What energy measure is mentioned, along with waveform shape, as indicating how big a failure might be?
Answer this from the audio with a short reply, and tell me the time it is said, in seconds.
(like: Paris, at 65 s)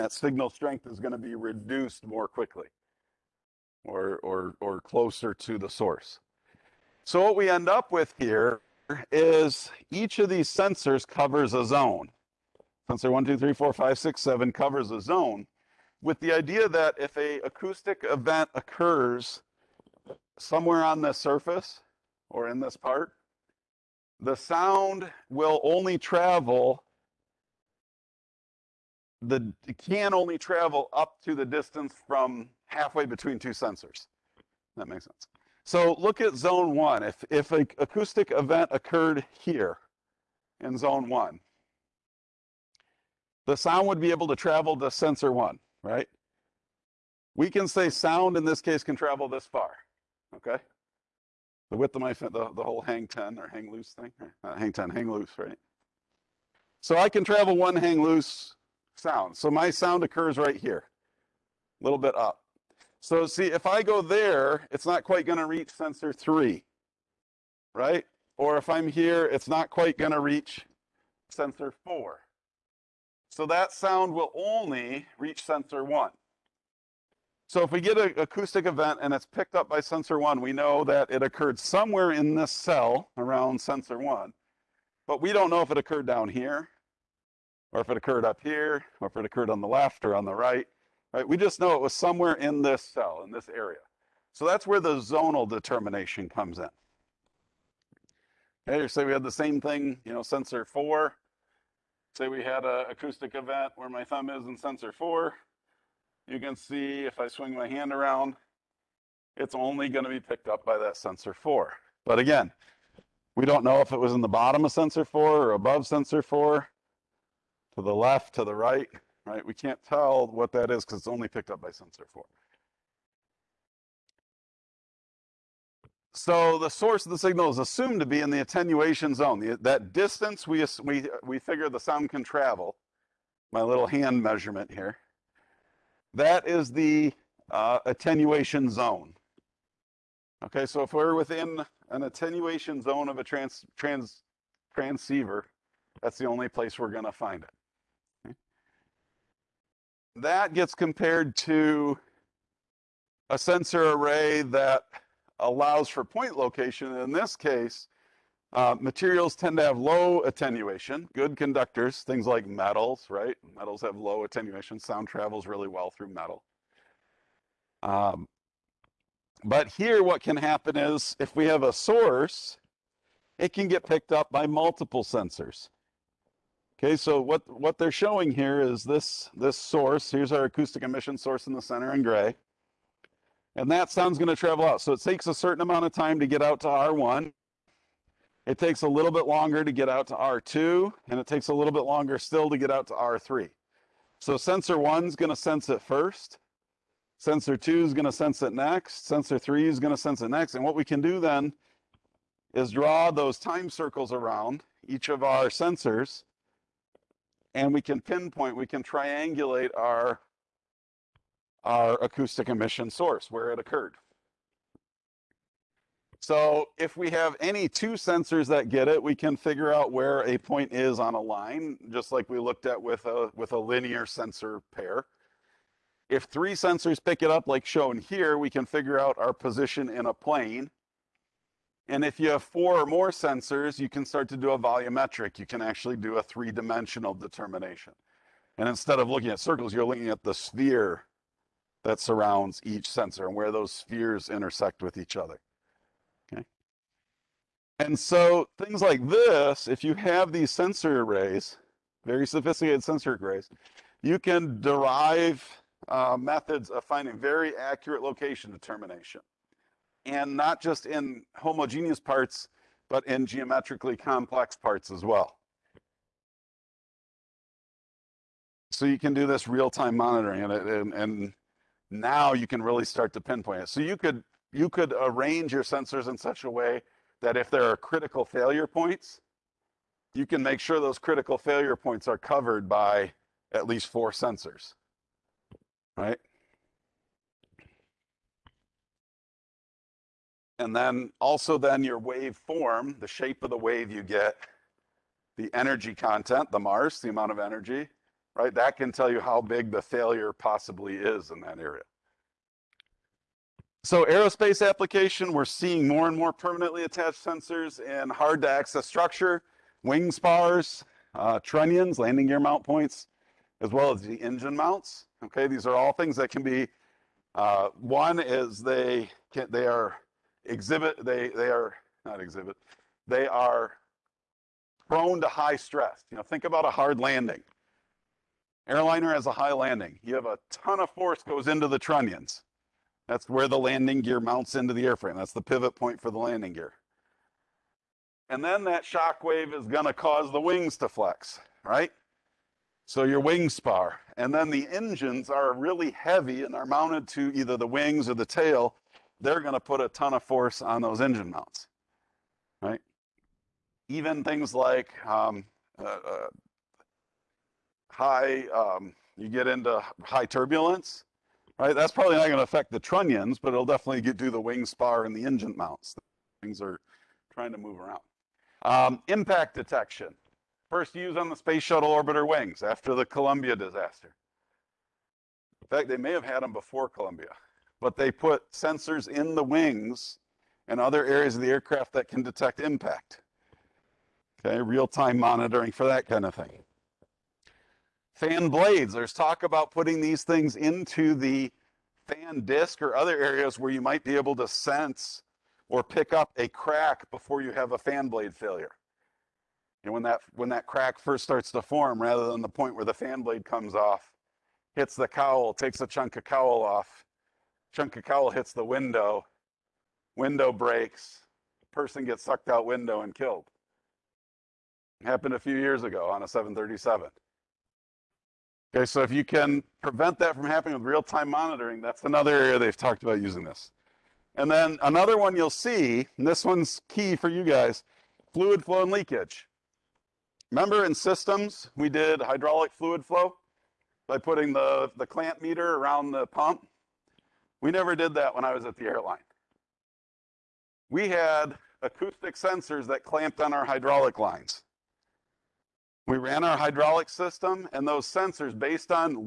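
MARSE, at 296 s.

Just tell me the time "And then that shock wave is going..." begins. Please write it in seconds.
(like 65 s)
338 s.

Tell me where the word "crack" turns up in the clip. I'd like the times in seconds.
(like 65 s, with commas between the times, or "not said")
396 s, 400 s.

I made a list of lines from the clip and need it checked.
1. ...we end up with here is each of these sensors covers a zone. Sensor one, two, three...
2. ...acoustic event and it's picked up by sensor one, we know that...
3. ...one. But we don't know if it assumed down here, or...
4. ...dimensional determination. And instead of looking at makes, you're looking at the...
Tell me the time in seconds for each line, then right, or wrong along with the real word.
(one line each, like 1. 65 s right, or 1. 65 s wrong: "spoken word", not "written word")
1. 7 s right
2. 78 s right
3. 83 s wrong: "occurred", not "assumed"
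4. 236 s wrong: "circles", not "makes".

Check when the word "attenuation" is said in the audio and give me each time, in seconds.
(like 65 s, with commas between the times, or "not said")
128 s, 137 s, 142 s, 160 s, 164 s.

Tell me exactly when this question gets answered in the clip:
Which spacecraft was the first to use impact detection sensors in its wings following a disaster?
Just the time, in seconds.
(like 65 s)
371 s.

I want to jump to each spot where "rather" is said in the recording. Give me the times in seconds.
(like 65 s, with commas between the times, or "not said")
402 s.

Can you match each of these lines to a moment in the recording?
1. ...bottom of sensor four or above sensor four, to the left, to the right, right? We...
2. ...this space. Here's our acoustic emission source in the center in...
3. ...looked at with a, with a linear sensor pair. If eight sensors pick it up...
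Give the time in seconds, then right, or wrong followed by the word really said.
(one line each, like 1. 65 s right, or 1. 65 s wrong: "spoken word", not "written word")
1. 114 s right
2. 179 s wrong: "source", not "space"
3. 222 s wrong: "three", not "eight".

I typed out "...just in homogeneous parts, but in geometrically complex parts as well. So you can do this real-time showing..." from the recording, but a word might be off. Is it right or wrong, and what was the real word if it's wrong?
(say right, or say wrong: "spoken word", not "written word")
wrong: "monitoring", not "showing".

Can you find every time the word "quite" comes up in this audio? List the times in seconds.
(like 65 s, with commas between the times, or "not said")
65 s, 69 s.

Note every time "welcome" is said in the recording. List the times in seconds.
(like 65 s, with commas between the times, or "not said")
not said.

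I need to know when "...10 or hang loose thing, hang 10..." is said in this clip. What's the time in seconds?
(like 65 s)
53 s.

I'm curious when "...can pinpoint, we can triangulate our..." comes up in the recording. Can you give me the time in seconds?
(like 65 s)
207 s.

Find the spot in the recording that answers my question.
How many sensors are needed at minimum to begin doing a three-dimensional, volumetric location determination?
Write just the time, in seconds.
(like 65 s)
232 s.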